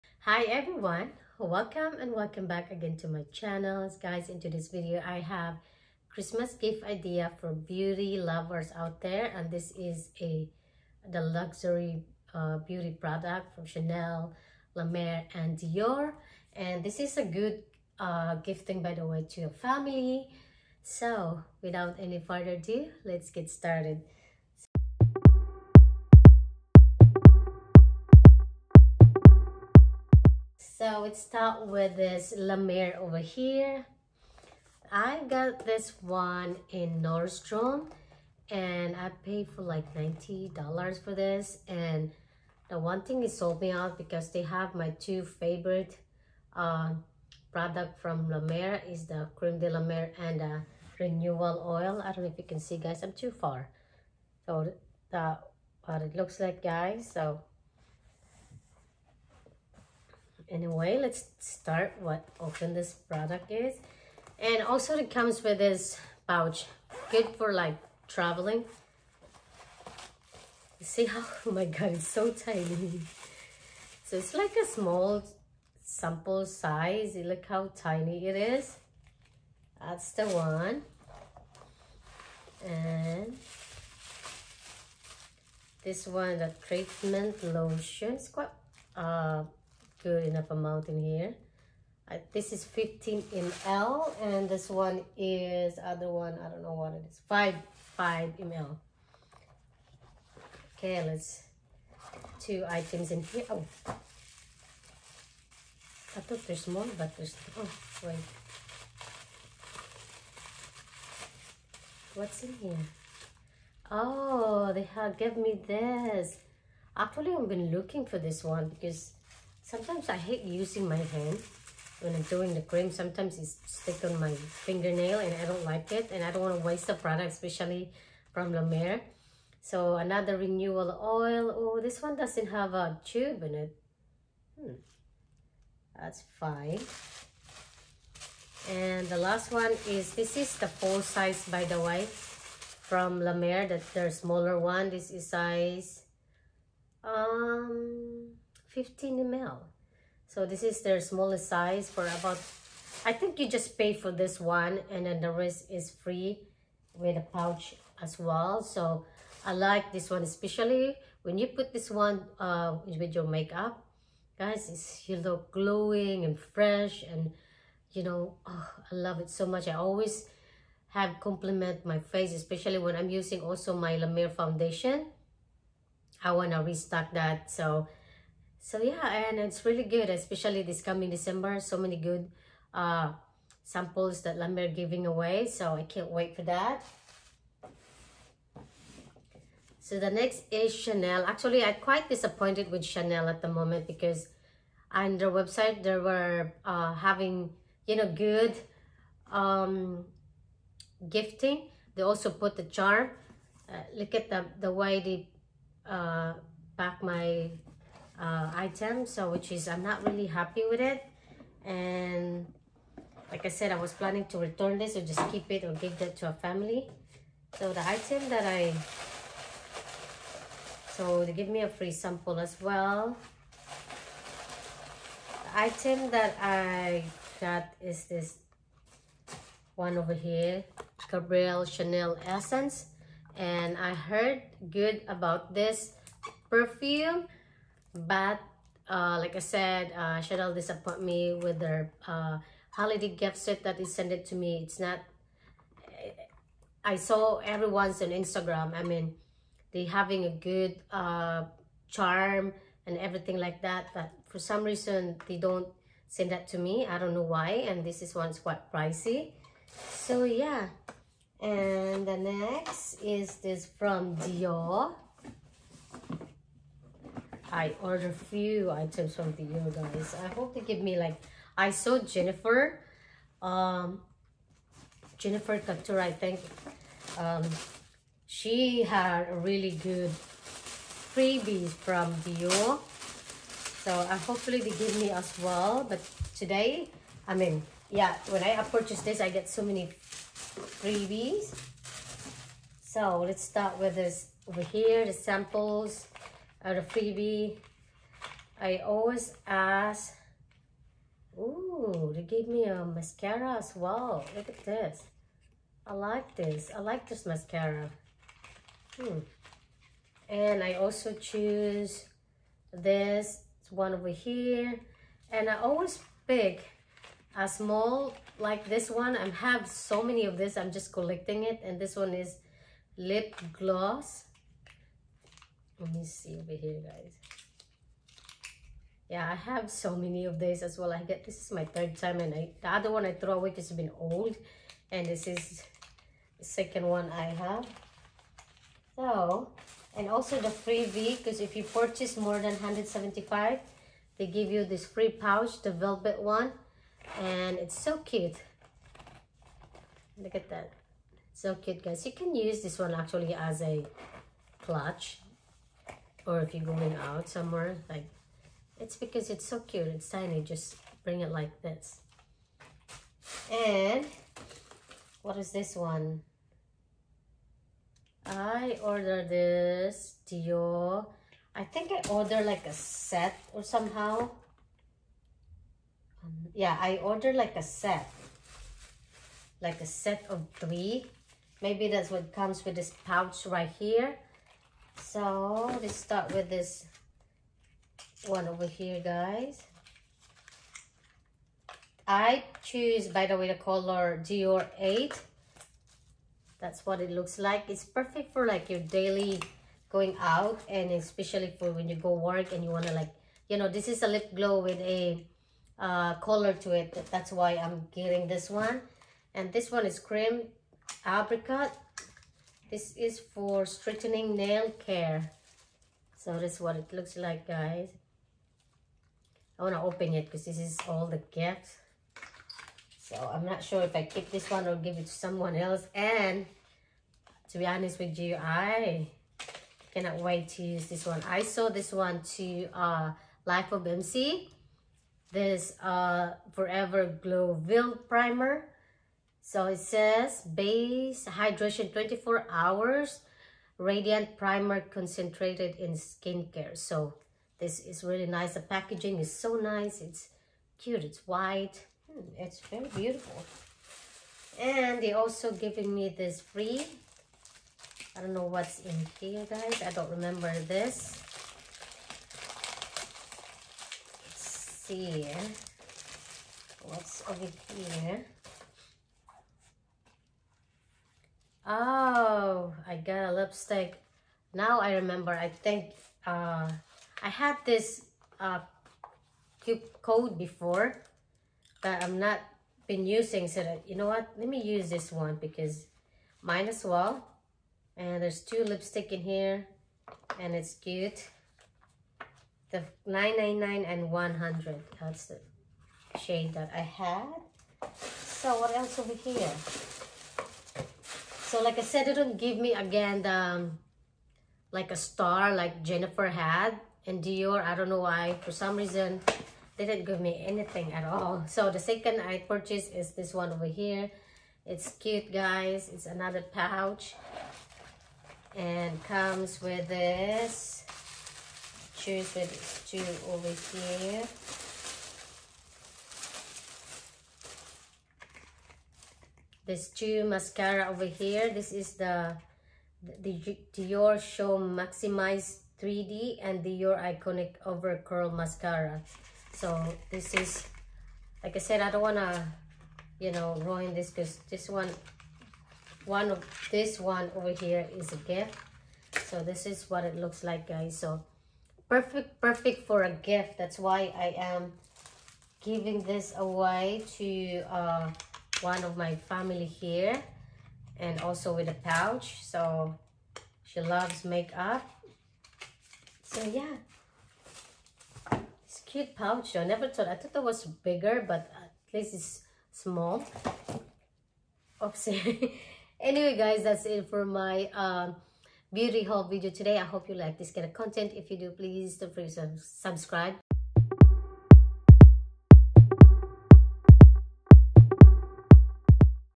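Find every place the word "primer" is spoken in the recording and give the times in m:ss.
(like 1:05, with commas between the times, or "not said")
7:18, 7:24.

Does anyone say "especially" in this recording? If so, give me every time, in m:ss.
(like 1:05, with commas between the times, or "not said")
2:07, 2:40, 2:52, 3:00, 6:40.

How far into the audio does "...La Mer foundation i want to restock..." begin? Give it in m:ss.
2:54.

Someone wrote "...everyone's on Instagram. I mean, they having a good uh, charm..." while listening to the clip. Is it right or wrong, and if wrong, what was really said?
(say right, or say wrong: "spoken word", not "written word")
right.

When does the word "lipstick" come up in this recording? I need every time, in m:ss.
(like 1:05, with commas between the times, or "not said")
7:53, 8:08.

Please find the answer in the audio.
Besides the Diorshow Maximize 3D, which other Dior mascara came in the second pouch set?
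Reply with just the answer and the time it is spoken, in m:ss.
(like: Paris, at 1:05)
Dior Iconic Over Curl, at 8:56.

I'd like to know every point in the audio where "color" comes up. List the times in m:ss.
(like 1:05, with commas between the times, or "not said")
6:33, 6:46.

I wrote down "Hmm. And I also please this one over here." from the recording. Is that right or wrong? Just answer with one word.
wrong.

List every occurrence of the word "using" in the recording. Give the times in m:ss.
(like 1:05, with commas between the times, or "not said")
2:00, 2:53, 8:03.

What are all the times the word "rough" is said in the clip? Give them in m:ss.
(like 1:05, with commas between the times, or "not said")
not said.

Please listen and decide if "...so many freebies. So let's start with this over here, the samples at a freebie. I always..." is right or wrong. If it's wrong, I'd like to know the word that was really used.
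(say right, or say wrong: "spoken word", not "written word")
right.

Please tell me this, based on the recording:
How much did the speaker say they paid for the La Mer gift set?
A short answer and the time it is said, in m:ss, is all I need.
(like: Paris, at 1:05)
$90, at 0:39.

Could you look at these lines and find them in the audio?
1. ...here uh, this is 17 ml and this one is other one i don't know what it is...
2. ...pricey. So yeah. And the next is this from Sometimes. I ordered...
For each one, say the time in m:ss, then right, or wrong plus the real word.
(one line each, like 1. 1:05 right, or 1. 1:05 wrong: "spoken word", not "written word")
1. 1:31 wrong: "15", not "17"
2. 4:18 wrong: "Dior", not "Sometimes".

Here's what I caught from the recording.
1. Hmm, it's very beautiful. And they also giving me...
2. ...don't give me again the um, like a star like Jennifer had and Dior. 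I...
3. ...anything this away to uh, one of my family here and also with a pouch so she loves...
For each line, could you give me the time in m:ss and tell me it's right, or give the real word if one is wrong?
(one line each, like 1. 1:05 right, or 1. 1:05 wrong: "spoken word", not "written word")
1. 7:32 right
2. 8:22 right
3. 9:15 wrong: "giving", not "anything".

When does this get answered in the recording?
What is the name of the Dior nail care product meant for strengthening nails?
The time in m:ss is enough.
6:49.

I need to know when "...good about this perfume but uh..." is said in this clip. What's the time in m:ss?
3:54.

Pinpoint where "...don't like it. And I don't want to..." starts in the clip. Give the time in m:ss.
2:05.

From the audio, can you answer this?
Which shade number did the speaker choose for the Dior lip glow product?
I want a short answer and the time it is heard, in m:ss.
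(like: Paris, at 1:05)
Dior 8, at 6:34.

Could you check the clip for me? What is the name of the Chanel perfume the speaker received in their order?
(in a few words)
Gabrielle Chanel Essence.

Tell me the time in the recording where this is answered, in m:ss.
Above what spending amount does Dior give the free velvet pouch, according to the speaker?
5:42.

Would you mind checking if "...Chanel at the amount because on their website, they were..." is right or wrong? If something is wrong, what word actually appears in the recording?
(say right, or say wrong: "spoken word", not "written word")
wrong: "moment", not "amount".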